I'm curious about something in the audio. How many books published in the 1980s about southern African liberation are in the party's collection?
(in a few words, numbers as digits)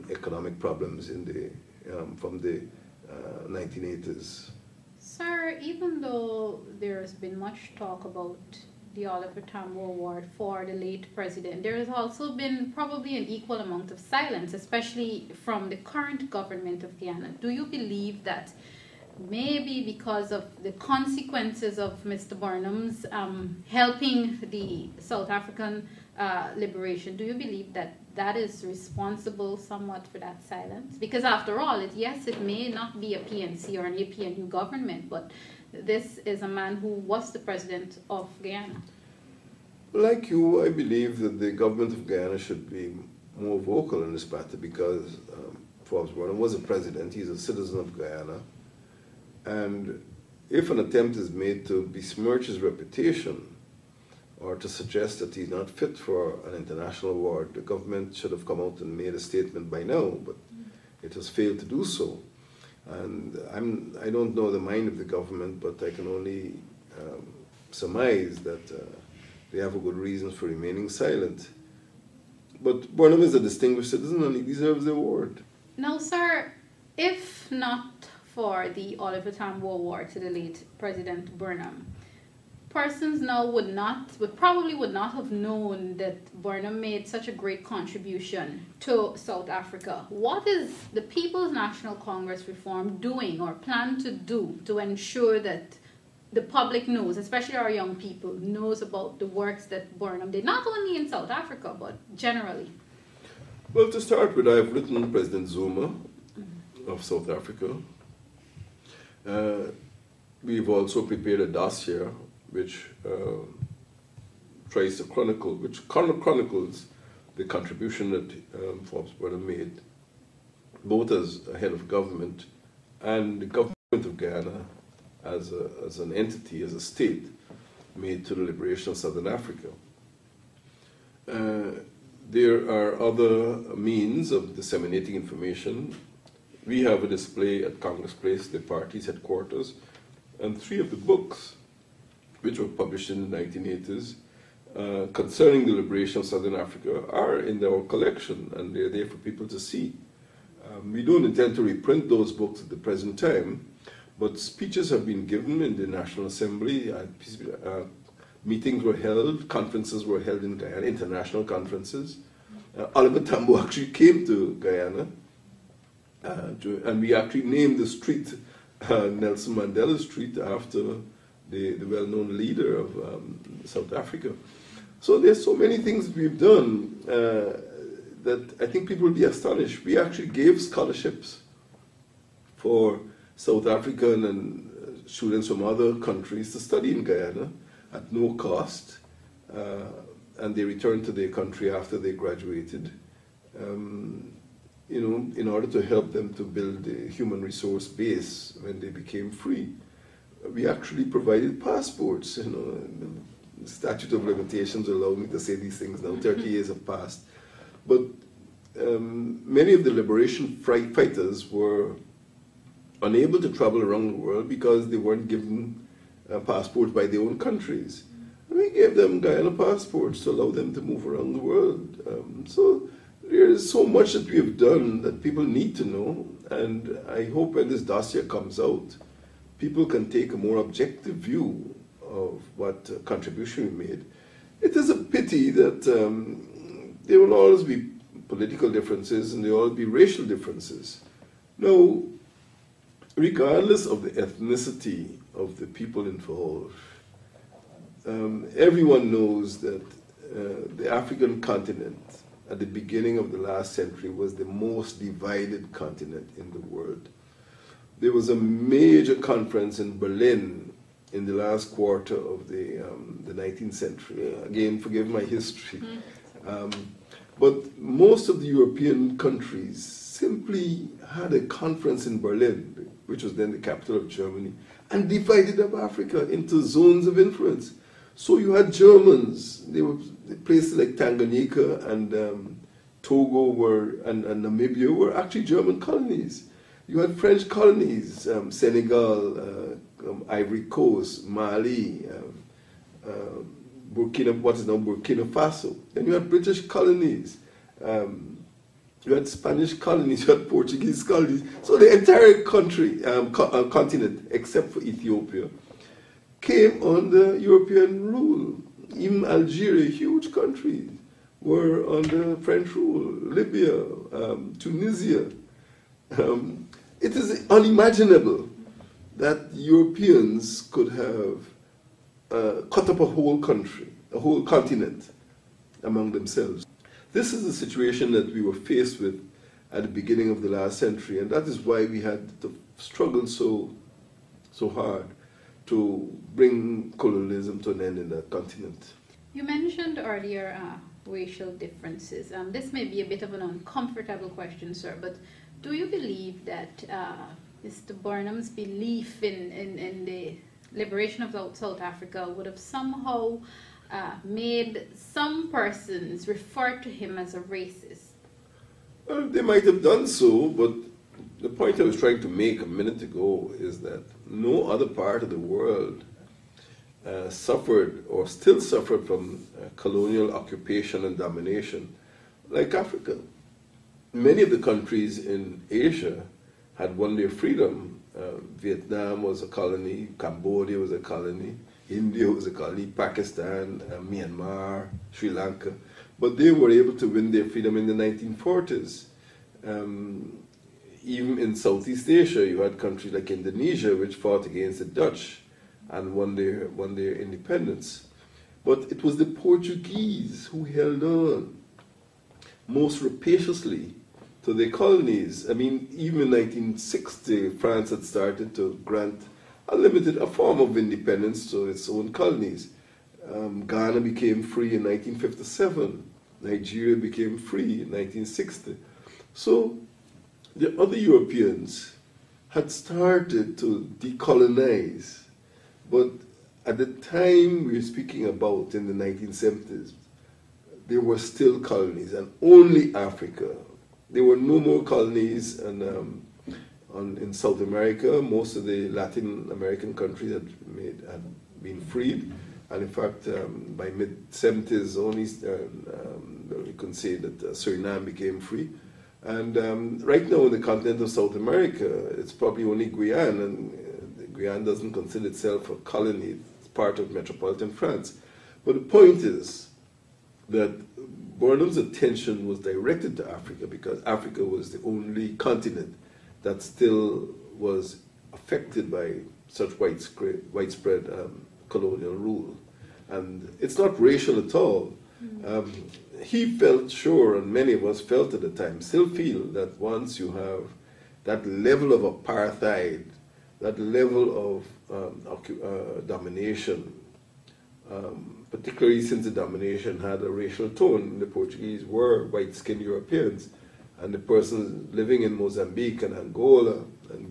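3.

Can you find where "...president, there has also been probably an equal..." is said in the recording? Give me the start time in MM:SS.
00:11.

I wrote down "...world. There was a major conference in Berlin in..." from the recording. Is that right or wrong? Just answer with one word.
right.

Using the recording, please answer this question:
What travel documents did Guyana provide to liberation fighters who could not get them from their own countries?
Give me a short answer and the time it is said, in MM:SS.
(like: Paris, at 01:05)
Guyana passports, at 03:39.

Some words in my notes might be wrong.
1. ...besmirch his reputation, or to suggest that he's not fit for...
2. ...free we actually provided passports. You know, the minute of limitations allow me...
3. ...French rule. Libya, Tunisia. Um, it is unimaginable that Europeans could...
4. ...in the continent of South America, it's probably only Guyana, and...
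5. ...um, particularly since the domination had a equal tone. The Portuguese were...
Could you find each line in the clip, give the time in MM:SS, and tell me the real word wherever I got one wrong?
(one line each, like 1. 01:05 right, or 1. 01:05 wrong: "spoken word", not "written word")
1. 00:51 right
2. 03:19 wrong: "statute", not "minute"
3. 05:12 right
4. 07:30 right
5. 08:07 wrong: "racial", not "equal".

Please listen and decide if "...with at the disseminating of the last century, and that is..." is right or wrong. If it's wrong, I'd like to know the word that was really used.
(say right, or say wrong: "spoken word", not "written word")
wrong: "beginning", not "disseminating".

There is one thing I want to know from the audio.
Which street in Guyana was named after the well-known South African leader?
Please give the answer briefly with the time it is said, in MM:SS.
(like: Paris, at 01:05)
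Nelson Mandela Street, at 02:49.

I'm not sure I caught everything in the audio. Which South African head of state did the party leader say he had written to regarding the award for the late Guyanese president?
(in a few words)
President Zuma.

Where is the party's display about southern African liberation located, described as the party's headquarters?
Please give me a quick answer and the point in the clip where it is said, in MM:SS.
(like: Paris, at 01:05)
Congress Place, at 02:17.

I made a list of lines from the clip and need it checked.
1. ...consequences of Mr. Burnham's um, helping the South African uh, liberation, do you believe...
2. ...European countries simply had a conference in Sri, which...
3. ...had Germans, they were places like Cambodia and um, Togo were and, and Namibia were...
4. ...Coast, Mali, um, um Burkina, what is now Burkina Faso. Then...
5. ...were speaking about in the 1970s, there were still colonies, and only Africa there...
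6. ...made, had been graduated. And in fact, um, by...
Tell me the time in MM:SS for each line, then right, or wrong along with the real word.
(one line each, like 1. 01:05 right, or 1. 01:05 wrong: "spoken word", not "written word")
1. 00:20 right
2. 04:28 wrong: "Berlin", not "Sri"
3. 04:38 wrong: "Tanganyika", not "Cambodia"
4. 04:50 right
5. 07:07 right
6. 07:20 wrong: "freed", not "graduated".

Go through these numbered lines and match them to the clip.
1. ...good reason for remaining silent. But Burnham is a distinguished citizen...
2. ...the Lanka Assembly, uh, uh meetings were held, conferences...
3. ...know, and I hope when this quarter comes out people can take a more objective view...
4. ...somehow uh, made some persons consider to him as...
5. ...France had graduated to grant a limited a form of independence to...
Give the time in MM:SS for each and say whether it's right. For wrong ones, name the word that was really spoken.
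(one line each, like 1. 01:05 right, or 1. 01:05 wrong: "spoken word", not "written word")
1. 01:09 right
2. 02:35 wrong: "National", not "Lanka"
3. 03:45 wrong: "dossier", not "quarter"
4. 05:52 wrong: "refer", not "consider"
5. 06:47 wrong: "started", not "graduated".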